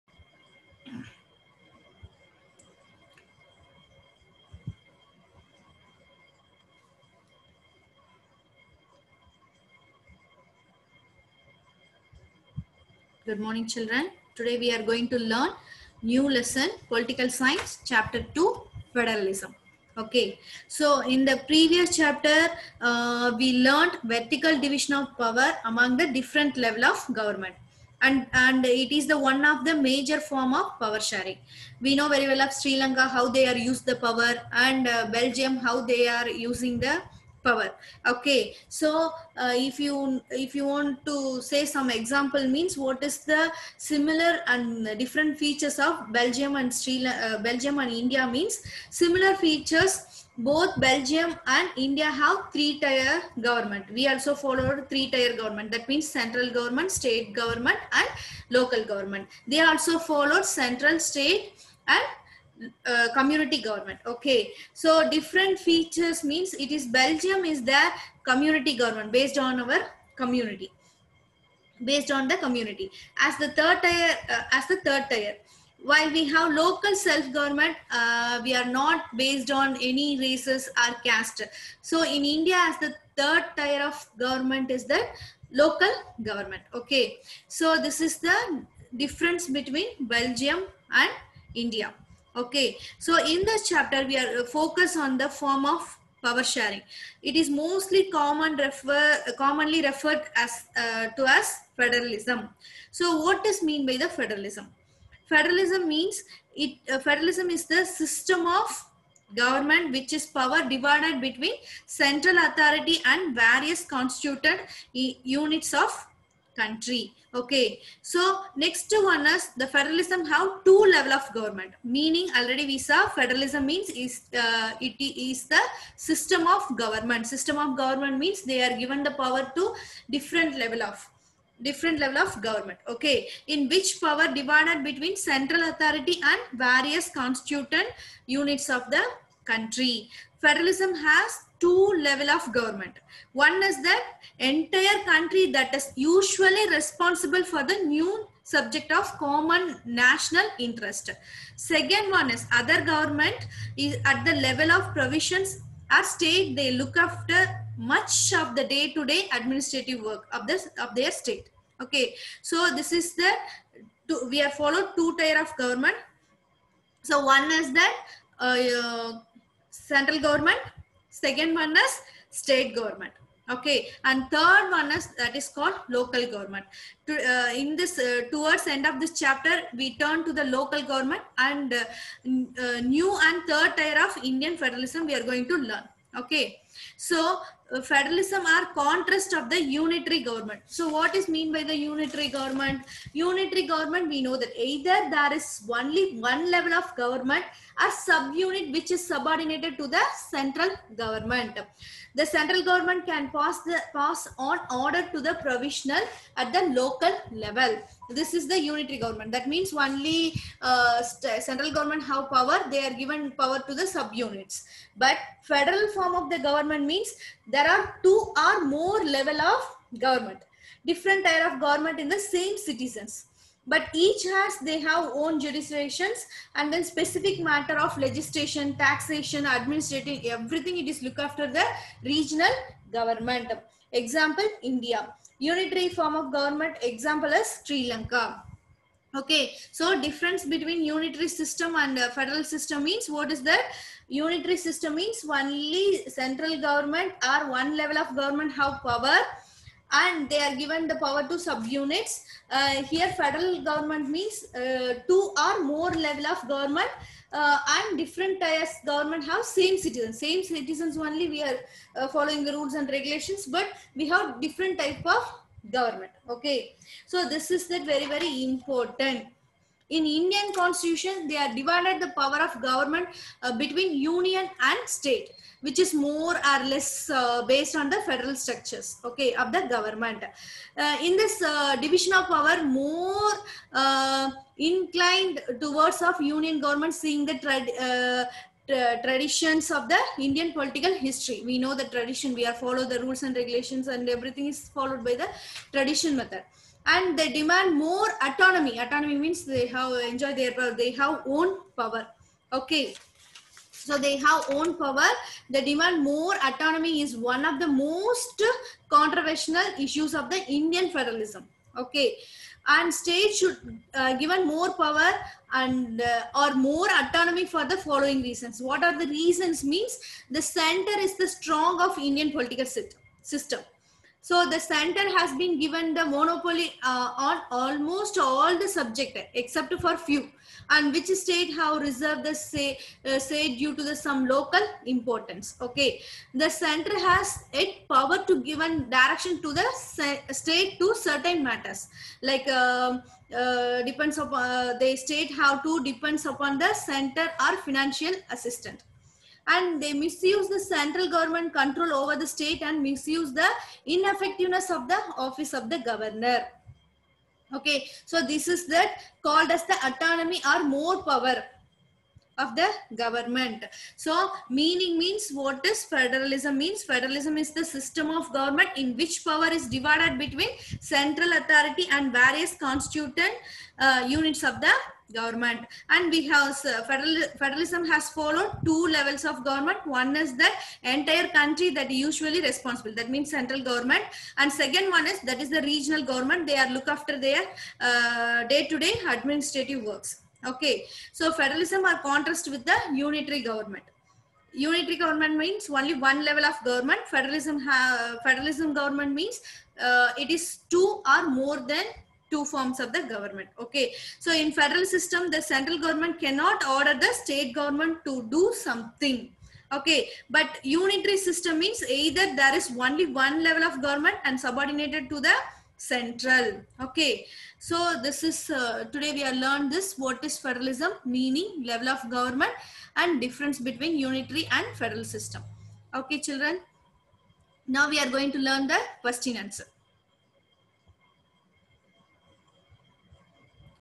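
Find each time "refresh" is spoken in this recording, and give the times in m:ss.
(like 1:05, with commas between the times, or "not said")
not said.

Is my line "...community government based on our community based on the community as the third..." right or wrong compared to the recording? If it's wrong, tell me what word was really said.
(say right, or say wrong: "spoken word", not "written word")
right.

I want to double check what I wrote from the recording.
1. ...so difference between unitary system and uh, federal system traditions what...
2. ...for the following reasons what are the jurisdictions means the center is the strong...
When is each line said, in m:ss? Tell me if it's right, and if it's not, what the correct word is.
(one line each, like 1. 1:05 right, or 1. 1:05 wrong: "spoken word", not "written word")
1. 3:59 wrong: "means", not "traditions"
2. 5:17 wrong: "reasons", not "jurisdictions".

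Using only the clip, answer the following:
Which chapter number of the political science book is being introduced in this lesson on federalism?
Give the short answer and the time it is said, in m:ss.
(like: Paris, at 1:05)
2, at 0:17.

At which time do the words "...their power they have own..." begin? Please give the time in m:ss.
5:00.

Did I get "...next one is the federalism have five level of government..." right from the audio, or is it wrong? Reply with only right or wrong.
wrong.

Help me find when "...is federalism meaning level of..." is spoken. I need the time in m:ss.
7:00.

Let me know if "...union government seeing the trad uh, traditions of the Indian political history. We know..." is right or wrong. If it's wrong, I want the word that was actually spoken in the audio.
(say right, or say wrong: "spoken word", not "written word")
right.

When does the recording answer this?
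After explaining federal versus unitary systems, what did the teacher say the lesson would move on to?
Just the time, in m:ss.
7:09.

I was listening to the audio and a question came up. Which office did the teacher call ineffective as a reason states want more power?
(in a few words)
Governor.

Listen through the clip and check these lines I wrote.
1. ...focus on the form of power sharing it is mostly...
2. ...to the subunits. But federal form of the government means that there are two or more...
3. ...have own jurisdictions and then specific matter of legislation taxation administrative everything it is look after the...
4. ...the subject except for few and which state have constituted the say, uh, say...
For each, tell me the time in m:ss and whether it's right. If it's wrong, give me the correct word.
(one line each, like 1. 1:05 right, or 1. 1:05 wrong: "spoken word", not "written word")
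1. 1:34 right
2. 3:33 right
3. 3:44 right
4. 5:28 wrong: "reserved", not "constituted".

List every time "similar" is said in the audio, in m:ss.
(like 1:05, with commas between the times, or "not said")
0:43, 0:48.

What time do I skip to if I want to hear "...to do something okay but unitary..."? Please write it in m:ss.
6:48.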